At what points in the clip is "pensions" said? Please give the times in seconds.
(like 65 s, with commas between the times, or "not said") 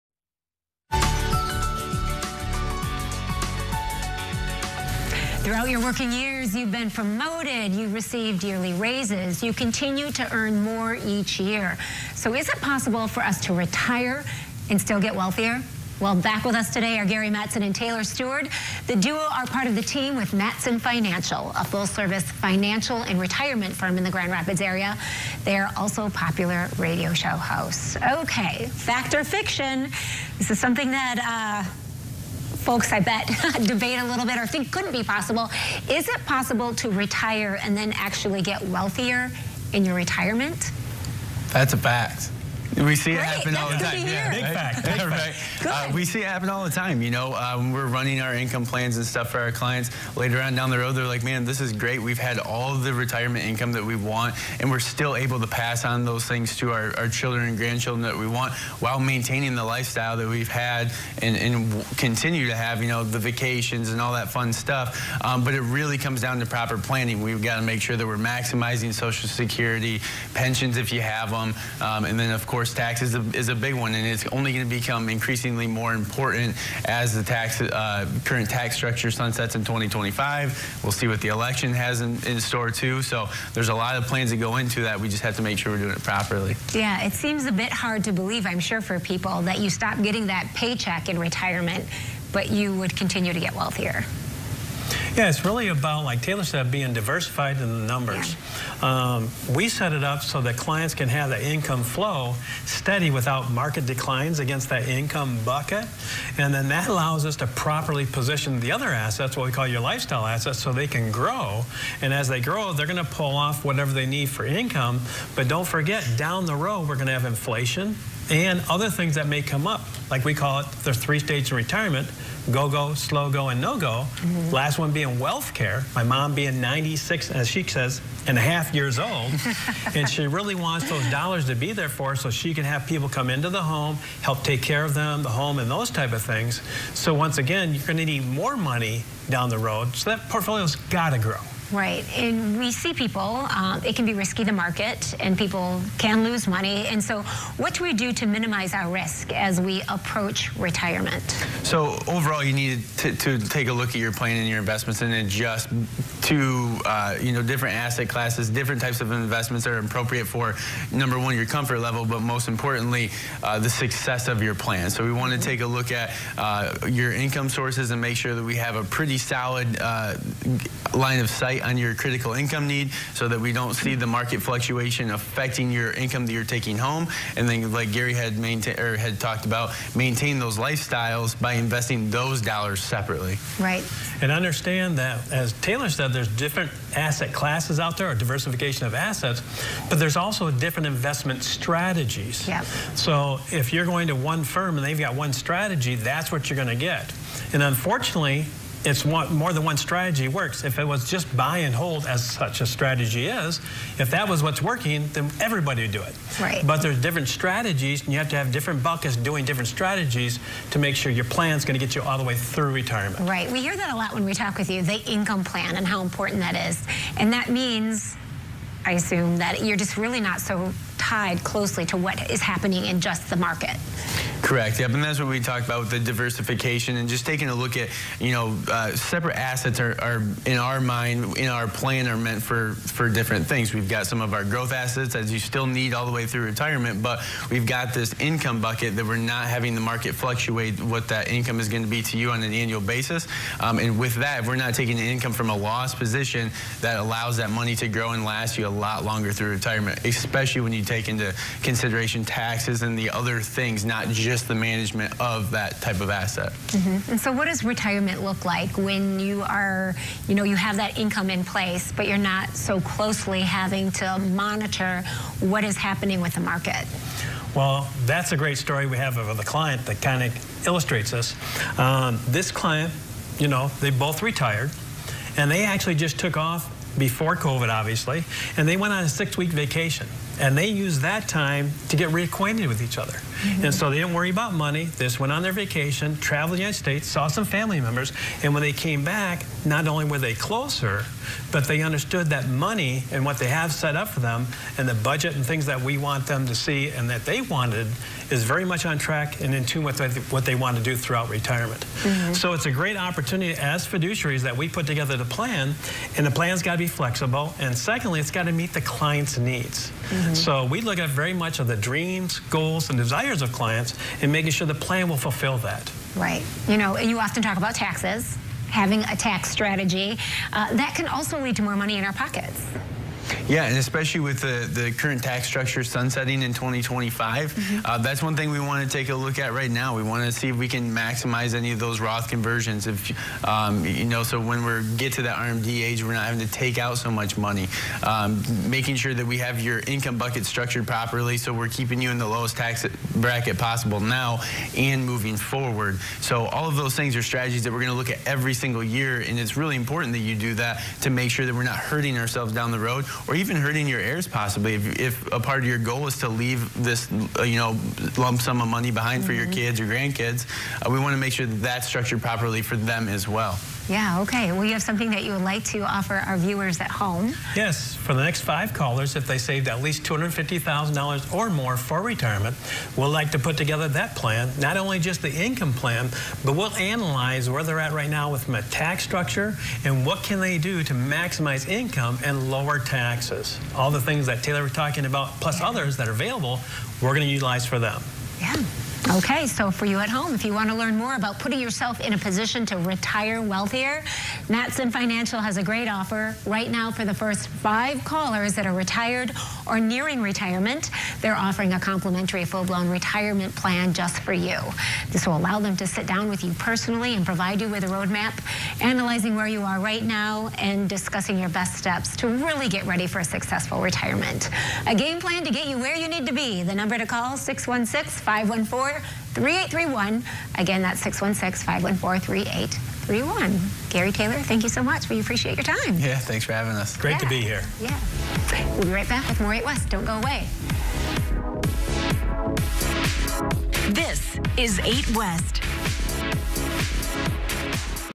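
70 s.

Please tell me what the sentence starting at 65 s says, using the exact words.
Um, but it really comes down to proper planning.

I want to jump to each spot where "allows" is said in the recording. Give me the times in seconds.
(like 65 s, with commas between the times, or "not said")
106 s, 246 s, 405 s.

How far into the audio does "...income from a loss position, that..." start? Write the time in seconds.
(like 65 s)
245 s.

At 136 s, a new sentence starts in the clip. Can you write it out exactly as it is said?
So once again, you're gonna need more money down the road.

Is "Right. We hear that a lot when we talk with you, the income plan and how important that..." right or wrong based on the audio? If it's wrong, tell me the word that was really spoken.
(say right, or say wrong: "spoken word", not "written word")
right.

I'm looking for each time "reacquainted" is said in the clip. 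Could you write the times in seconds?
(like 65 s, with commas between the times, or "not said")
282 s.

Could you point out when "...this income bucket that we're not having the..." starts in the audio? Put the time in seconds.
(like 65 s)
237 s.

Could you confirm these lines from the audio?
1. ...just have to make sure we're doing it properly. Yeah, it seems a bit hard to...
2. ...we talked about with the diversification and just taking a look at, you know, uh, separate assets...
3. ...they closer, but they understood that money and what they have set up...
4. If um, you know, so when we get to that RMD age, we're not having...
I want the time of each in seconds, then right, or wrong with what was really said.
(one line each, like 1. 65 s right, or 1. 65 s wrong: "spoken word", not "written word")
1. 85 s right
2. 225 s right
3. 290 s right
4. 332 s right.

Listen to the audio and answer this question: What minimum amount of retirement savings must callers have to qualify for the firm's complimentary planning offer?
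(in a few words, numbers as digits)
$250,000.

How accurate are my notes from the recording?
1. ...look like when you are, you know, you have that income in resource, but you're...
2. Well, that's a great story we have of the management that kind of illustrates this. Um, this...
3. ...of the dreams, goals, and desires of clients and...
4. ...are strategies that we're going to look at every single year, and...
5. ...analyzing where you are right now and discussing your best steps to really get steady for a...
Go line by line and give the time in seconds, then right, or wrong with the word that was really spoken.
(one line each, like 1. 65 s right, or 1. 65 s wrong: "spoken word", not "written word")
1. 258 s wrong: "place", not "resource"
2. 267 s wrong: "client", not "management"
3. 311 s right
4. 347 s right
5. 408 s wrong: "ready", not "steady".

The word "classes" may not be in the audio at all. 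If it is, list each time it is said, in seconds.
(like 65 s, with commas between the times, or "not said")
158 s, 187 s.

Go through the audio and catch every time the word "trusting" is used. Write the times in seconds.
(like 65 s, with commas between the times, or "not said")
not said.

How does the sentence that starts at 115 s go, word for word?
But don't forget, down the road, we're going to have inflation and other things that may come up.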